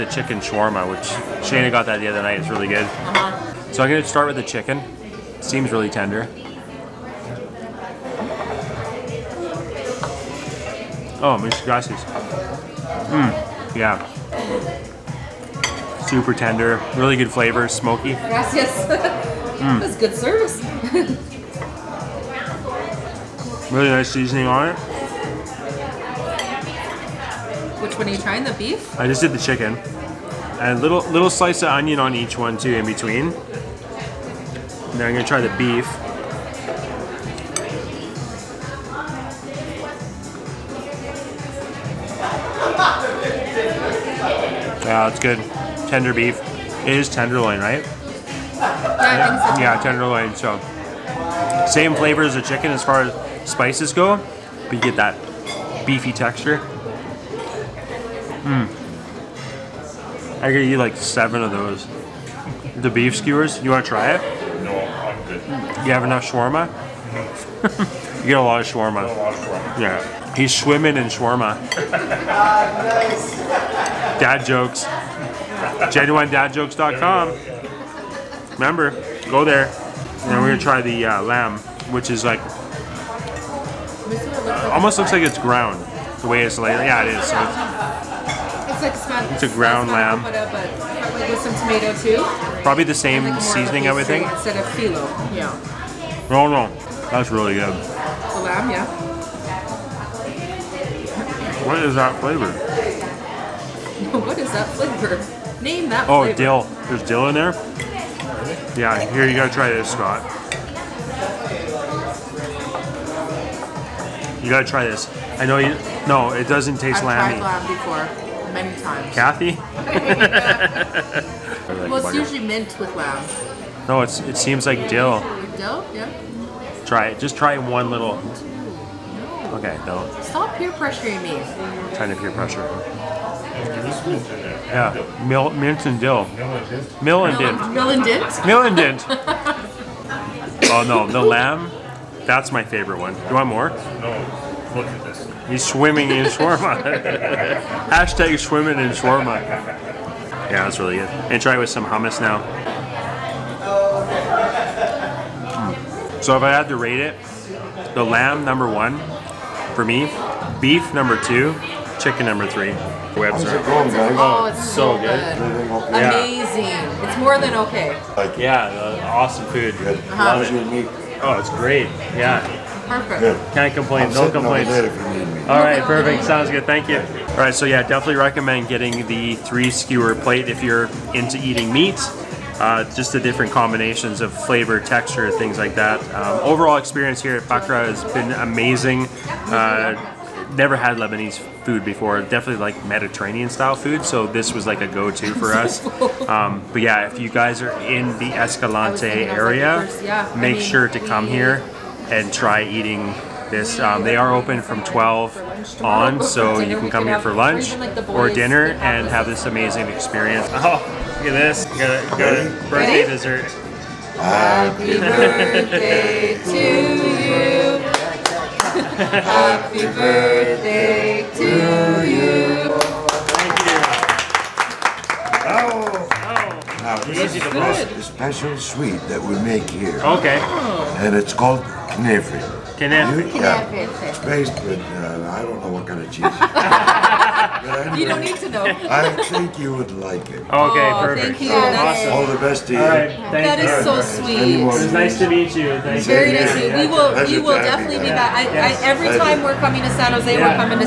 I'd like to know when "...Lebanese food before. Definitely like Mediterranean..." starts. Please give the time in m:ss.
3:10.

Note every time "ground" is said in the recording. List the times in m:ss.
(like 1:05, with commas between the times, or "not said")
1:25, 1:29.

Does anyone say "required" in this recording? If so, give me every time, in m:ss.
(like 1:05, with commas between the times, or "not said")
not said.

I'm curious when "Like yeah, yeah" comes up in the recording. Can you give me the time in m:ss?
2:48.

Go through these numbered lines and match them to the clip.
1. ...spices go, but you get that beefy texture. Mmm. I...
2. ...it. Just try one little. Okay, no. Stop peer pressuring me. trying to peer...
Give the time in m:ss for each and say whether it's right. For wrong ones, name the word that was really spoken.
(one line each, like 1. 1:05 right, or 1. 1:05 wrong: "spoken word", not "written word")
1. 0:53 right
2. 2:07 right.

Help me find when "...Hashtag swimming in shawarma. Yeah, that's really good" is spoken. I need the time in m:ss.
2:27.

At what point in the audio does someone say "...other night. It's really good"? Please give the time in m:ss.
0:02.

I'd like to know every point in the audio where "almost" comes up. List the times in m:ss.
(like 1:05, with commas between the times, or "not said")
1:24.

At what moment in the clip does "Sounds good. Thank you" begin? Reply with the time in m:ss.
2:56.